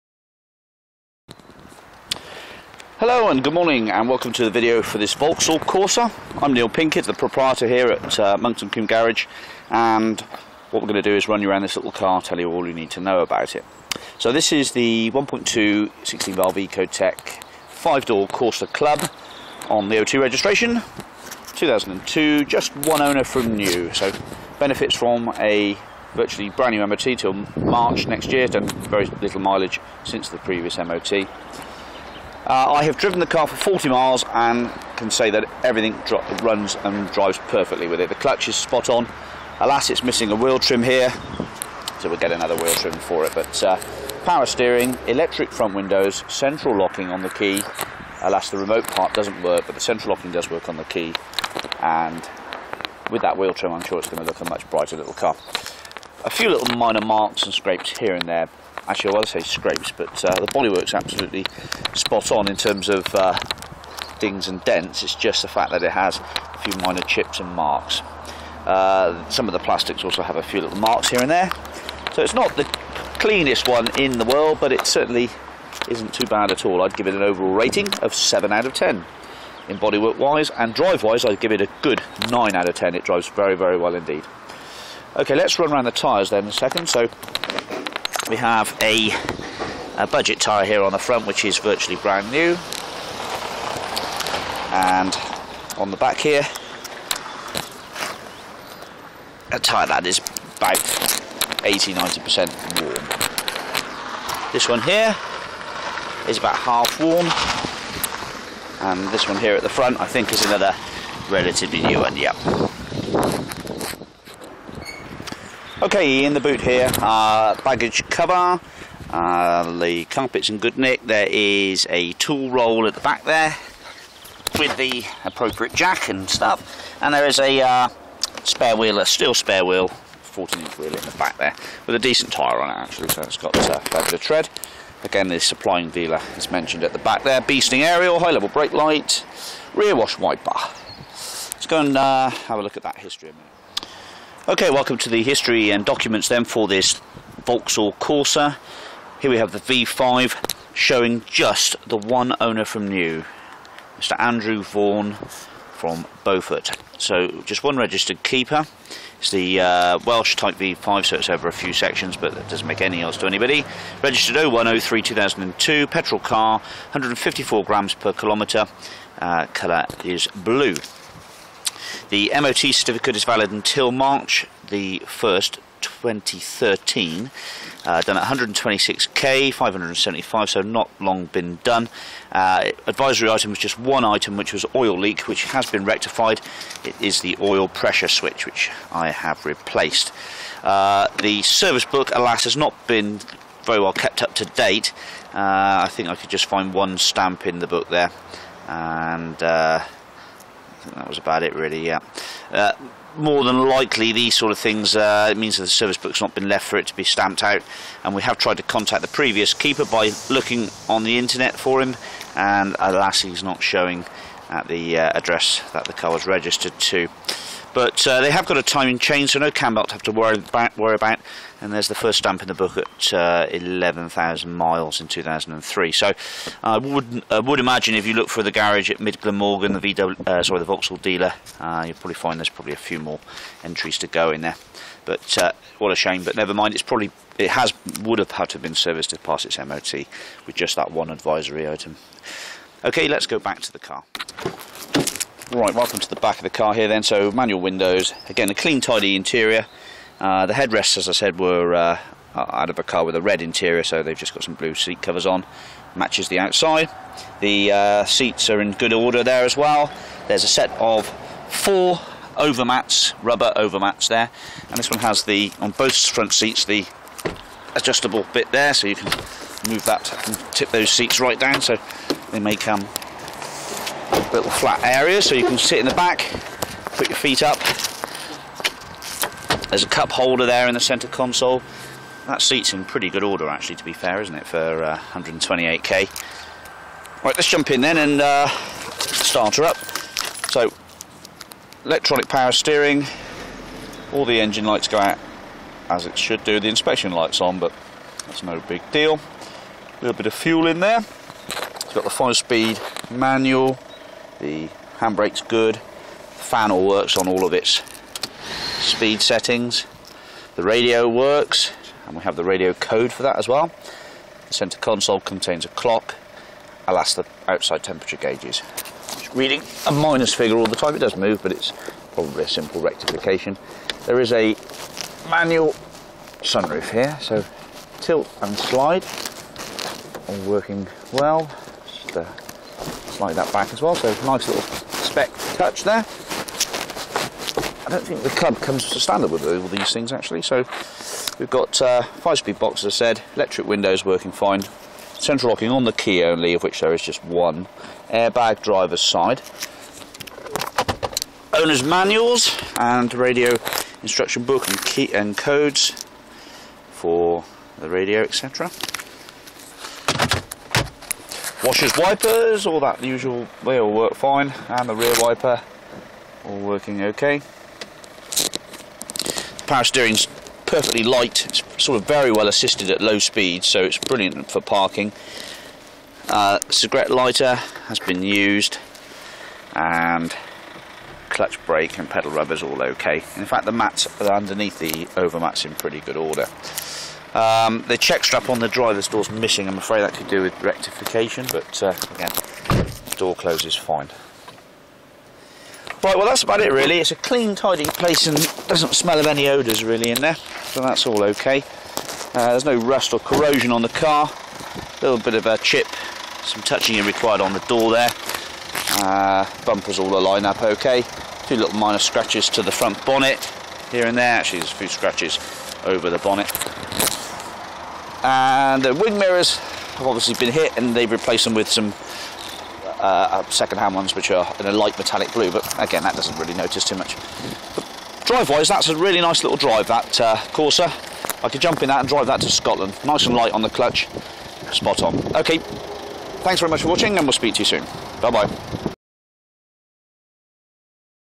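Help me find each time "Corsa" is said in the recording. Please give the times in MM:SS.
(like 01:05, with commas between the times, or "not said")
00:05, 00:18, 02:27, 07:10.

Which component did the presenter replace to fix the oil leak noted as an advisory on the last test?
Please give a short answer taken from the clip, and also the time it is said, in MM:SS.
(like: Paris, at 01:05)
oil pressure switch, at 03:07.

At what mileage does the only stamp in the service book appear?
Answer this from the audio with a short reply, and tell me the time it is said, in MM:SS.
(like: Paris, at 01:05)
11,000, at 03:43.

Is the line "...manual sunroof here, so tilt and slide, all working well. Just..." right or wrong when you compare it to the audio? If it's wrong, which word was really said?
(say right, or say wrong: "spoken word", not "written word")
right.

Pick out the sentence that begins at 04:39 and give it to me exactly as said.
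There's a cup holder there in the centre console.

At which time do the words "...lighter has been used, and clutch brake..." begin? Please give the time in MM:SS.
06:17.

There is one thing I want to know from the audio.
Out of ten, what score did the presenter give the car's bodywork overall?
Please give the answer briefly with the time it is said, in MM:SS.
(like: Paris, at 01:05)
7, at 01:18.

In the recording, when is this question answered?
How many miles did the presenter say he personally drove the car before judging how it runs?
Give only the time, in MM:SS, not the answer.
00:33.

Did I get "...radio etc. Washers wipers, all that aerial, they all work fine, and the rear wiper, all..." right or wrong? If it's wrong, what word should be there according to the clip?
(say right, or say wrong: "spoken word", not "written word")
wrong: "usual", not "aerial".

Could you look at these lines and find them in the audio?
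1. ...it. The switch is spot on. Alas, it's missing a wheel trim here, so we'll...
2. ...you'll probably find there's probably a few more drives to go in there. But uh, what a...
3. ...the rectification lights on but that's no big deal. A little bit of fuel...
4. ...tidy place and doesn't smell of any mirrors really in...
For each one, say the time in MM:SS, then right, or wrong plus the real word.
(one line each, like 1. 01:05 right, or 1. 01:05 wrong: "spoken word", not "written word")
1. 00:38 wrong: "clutch", not "switch"
2. 03:51 wrong: "entries", not "drives"
3. 04:56 wrong: "inspection", not "rectification"
4. 06:37 wrong: "odours", not "mirrors".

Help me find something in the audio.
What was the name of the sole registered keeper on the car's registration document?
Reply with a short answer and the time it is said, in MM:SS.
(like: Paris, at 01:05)
Andrew Vaughan, at 02:33.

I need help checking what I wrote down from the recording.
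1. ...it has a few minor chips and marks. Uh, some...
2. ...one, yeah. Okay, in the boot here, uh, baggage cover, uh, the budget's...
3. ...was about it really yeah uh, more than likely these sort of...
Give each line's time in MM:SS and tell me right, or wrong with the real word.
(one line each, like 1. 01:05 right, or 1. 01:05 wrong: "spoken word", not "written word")
1. 01:05 right
2. 01:51 wrong: "carpet", not "budget"
3. 03:21 right.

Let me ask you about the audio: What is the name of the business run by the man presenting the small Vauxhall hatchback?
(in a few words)
Monkton Coombe Garage.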